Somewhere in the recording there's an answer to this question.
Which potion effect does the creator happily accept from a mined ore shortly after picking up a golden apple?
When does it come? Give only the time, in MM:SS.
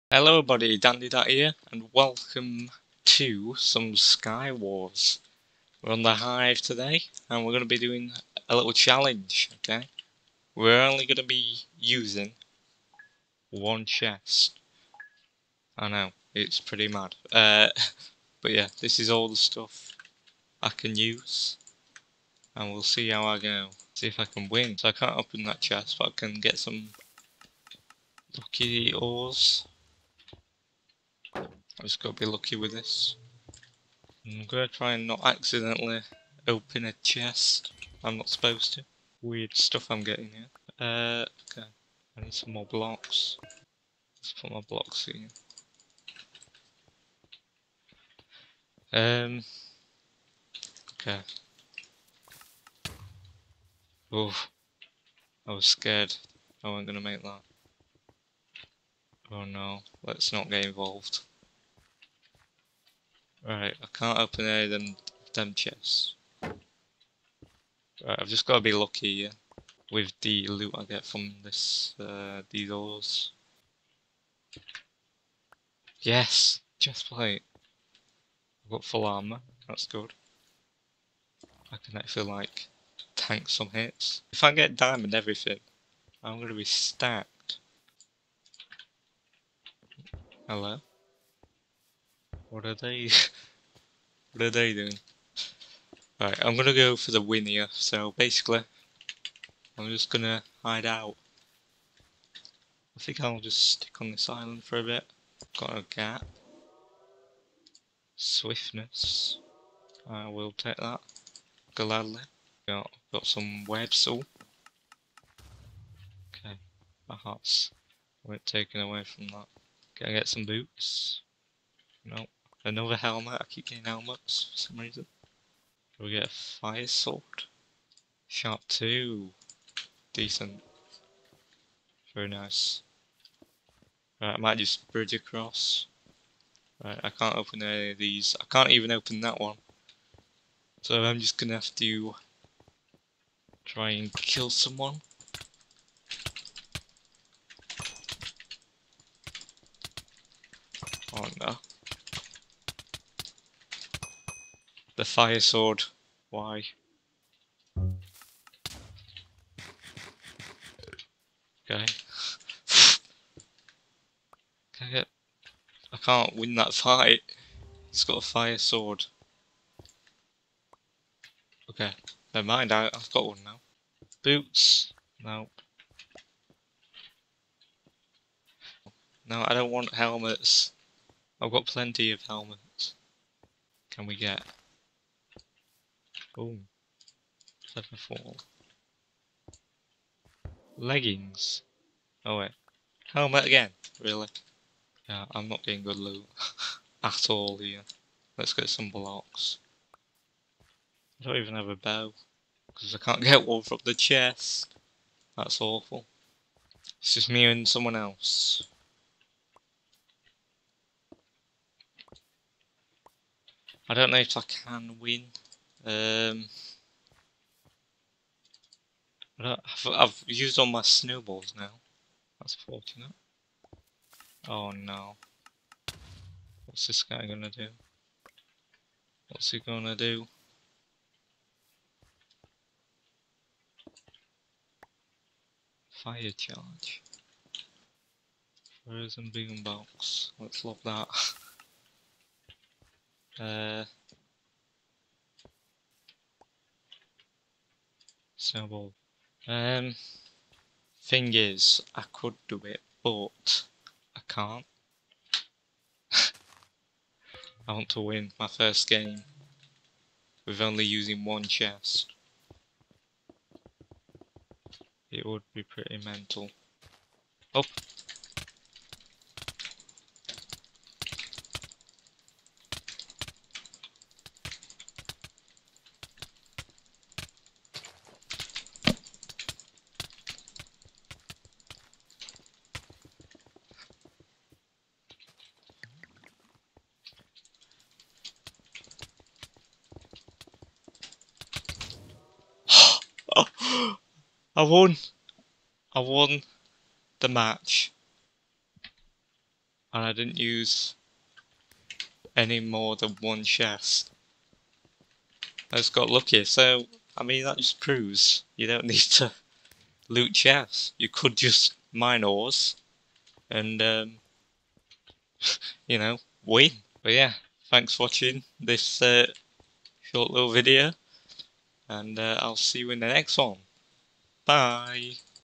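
01:48.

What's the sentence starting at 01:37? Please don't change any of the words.
So basically, I'm just gonna hide out.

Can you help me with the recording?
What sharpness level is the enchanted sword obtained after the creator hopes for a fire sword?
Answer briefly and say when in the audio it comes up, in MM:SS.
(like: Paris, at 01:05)
Sharp 2, at 02:08.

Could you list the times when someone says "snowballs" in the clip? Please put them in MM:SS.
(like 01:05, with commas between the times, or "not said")
03:40, 04:08.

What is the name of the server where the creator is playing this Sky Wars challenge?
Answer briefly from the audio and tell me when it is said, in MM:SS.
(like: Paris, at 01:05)
The Hive, at 00:06.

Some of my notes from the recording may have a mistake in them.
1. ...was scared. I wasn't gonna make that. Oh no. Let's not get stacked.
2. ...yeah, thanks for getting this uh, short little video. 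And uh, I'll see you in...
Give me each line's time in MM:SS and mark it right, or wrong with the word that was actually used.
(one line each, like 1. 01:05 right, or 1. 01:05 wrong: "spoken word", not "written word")
1. 00:55 wrong: "involved", not "stacked"
2. 05:17 wrong: "watching", not "getting".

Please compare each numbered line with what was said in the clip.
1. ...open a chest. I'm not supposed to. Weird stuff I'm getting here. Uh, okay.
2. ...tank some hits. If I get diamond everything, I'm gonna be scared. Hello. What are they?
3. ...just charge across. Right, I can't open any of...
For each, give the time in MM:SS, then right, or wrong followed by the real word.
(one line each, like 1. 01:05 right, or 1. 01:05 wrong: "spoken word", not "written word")
1. 00:36 right
2. 01:23 wrong: "stacked", not "scared"
3. 02:14 wrong: "bridge", not "charge".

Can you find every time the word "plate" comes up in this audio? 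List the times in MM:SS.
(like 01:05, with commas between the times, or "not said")
01:17.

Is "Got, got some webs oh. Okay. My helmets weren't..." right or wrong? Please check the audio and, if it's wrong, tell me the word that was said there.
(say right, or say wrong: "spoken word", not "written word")
wrong: "hearts", not "helmets".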